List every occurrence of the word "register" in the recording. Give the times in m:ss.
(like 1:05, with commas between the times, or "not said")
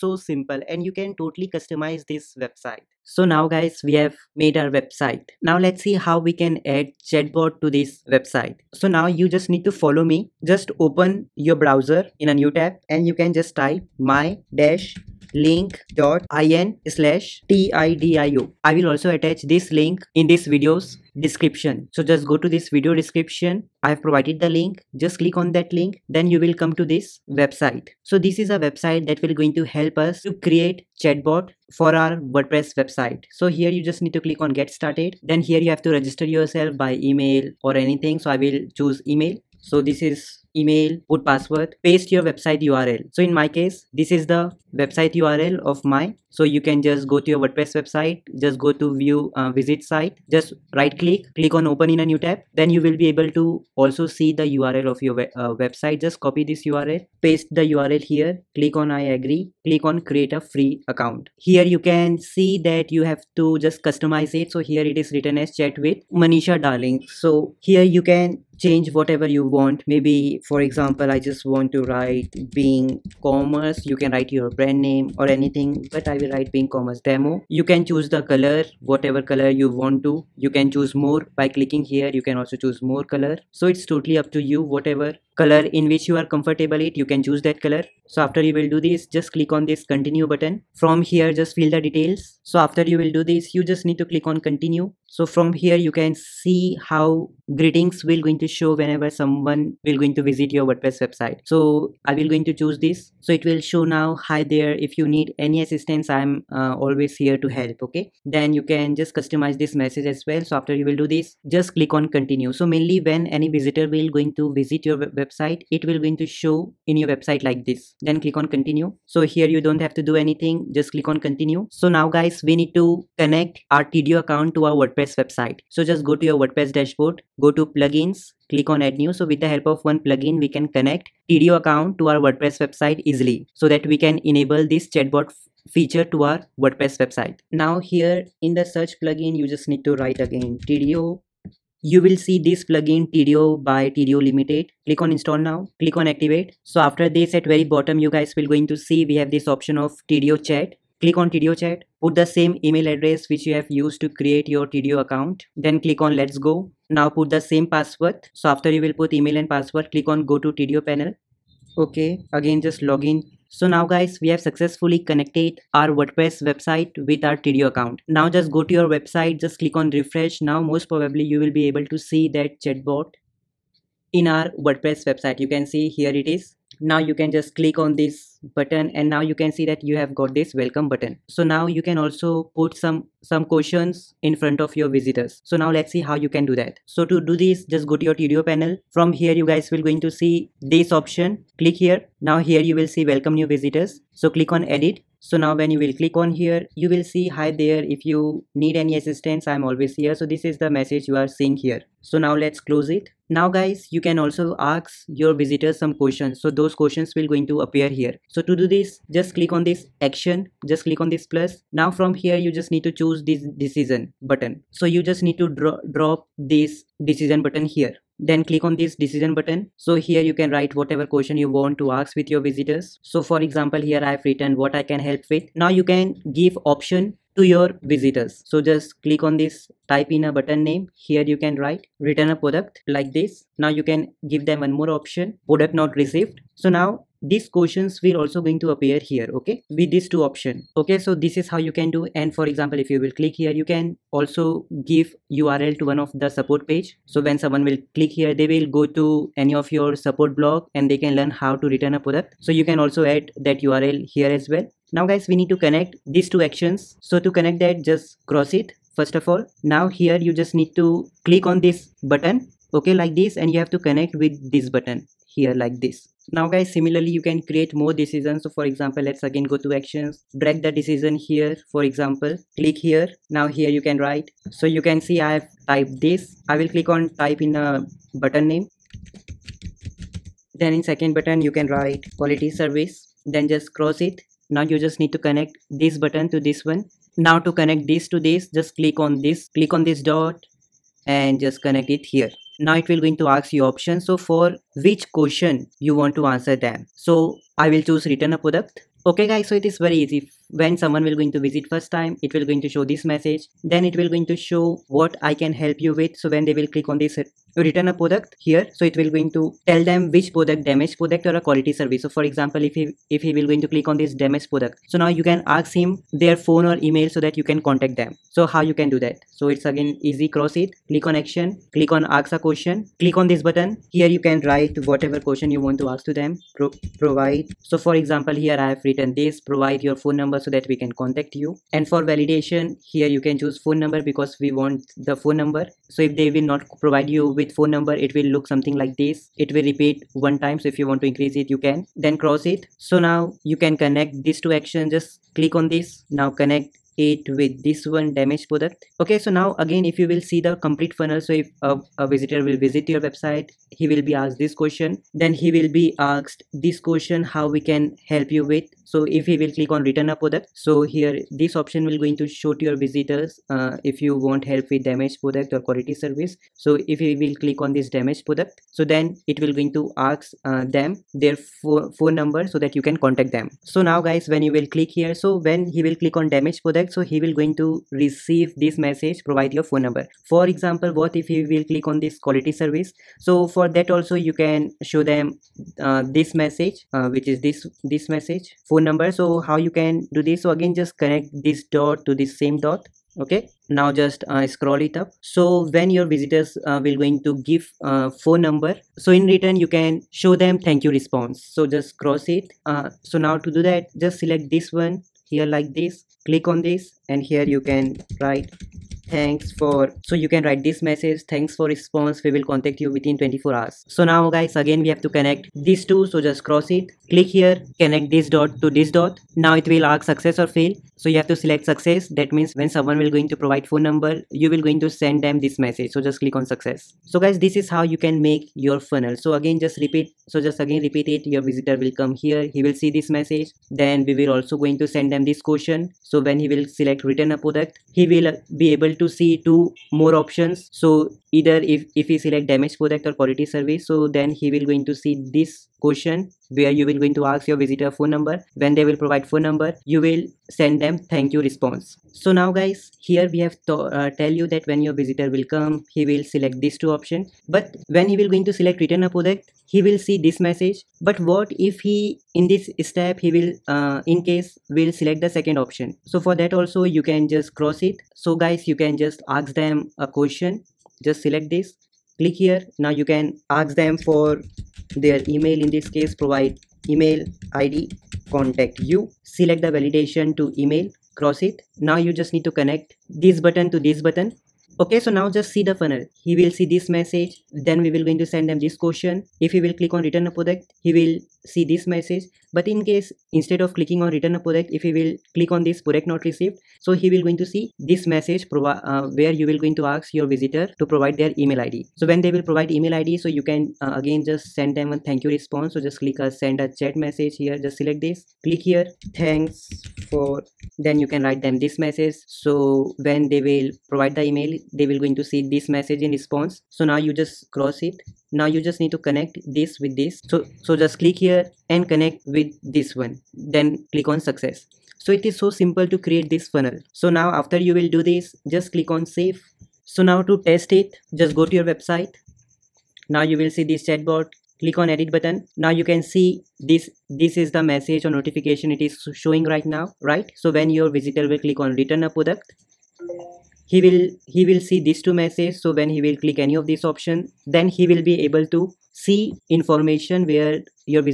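0:35.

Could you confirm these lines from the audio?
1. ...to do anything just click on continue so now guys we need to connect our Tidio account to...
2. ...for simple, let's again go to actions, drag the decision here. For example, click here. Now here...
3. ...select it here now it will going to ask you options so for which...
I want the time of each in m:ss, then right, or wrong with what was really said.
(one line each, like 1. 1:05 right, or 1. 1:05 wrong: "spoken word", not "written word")
1. 1:59 right
2. 4:28 wrong: "example", not "simple"
3. 4:51 wrong: "connect", not "select".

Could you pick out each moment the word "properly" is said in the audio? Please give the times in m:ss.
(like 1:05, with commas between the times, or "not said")
not said.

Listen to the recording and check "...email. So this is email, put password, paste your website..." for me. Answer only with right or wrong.
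right.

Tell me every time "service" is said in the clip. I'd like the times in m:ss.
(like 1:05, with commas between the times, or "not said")
4:42, 5:11, 6:05, 6:22, 7:23.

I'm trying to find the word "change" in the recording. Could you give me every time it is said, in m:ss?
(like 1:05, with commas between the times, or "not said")
1:08.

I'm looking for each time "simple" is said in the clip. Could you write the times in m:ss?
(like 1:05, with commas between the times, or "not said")
0:00, 8:45.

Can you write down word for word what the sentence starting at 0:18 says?
I will also attach this link in this video's description.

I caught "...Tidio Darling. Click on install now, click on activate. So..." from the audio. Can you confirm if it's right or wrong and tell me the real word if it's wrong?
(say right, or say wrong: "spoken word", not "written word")
wrong: "Limited", not "Darling".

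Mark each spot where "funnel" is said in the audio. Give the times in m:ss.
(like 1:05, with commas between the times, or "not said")
5:50, 7:08, 8:05, 8:46.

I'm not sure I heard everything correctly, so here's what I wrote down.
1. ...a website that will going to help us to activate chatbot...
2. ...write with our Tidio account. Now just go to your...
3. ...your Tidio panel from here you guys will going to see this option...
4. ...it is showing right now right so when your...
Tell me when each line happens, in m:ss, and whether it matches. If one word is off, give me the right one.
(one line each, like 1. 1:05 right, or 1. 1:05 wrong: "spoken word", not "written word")
1. 0:28 wrong: "create", not "activate"
2. 2:46 wrong: "website", not "write"
3. 3:08 right
4. 8:58 right.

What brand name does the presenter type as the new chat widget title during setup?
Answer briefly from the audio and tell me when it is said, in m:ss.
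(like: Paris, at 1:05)
being commerce demo, at 1:16.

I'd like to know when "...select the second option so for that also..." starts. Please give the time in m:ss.
7:44.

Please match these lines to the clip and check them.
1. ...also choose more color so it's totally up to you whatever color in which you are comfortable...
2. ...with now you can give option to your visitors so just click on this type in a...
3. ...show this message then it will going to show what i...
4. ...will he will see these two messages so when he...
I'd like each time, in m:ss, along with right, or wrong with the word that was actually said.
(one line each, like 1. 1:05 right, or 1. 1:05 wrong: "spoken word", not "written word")
1. 1:22 right
2. 3:45 right
3. 5:02 right
4. 9:03 right.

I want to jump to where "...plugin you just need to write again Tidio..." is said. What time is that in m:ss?
2:19.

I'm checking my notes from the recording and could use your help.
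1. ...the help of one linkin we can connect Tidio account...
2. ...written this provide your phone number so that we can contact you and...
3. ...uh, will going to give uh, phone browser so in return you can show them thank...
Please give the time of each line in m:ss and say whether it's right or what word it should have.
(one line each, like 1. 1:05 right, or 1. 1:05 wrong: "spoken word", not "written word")
1. 2:09 wrong: "plugin", not "linkin"
2. 5:28 right
3. 6:36 wrong: "number", not "browser".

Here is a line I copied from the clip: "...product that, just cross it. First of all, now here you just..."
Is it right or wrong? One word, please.
wrong.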